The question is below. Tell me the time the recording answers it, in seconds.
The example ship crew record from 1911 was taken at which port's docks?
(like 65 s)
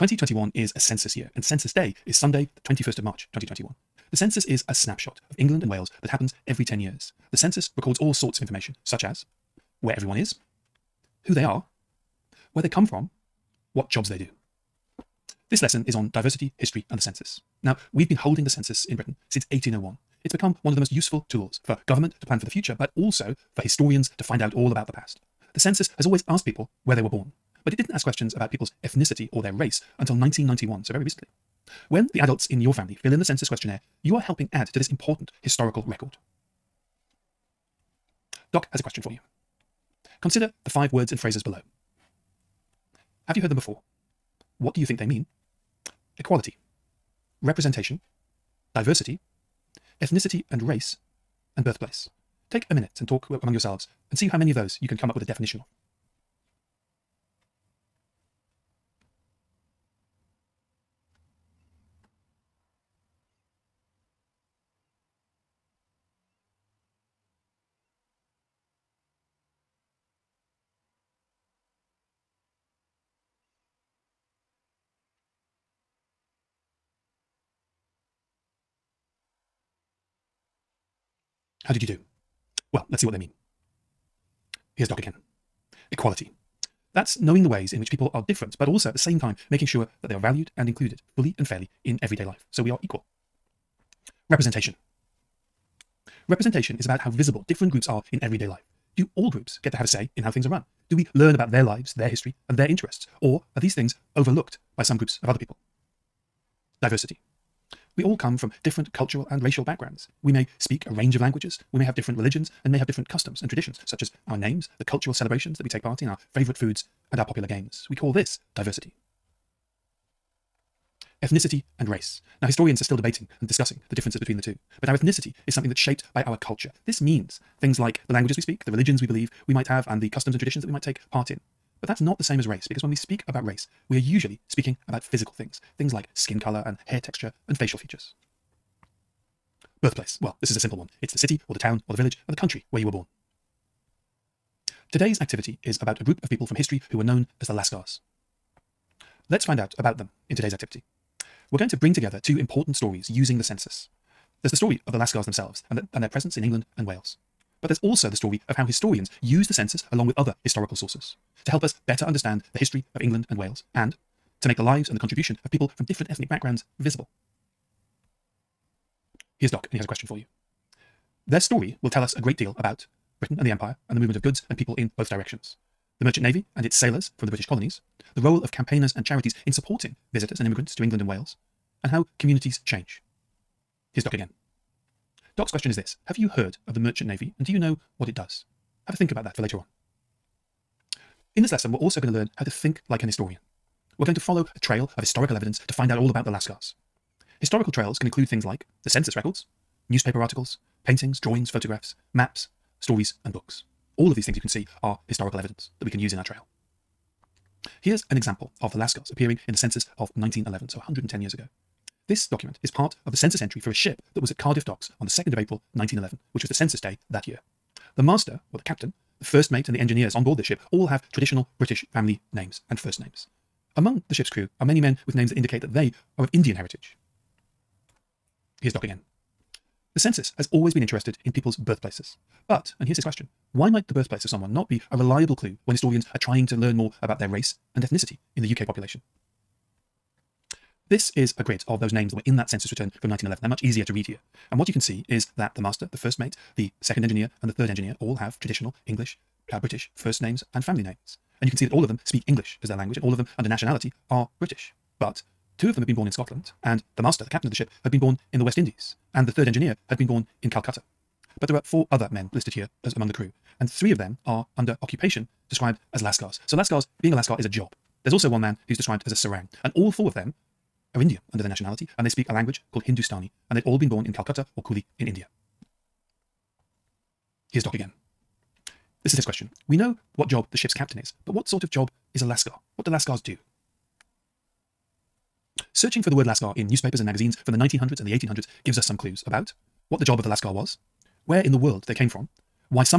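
214 s.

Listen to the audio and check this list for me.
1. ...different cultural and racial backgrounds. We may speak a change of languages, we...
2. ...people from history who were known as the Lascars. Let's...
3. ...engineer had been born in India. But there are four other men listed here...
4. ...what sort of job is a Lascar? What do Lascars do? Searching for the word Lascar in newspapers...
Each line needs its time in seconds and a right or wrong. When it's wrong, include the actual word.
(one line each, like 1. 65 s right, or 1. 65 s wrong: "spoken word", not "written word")
1. 108 s wrong: "range", not "change"
2. 146 s right
3. 259 s wrong: "Calcutta", not "India"
4. 281 s right.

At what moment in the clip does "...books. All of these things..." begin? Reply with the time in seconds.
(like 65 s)
203 s.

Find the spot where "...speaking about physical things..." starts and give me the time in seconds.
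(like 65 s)
134 s.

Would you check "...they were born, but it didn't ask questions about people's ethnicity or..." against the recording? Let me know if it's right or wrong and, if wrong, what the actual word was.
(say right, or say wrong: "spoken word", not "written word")
right.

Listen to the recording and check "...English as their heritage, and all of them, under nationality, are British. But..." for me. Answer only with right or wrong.
wrong.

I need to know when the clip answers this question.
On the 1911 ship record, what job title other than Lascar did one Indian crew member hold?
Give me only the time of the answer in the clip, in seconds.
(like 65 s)
269 s.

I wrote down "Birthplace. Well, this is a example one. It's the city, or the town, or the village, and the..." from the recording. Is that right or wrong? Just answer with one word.
wrong.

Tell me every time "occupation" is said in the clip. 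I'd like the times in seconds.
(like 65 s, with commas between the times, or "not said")
264 s.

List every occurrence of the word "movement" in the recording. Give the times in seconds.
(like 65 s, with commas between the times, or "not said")
173 s.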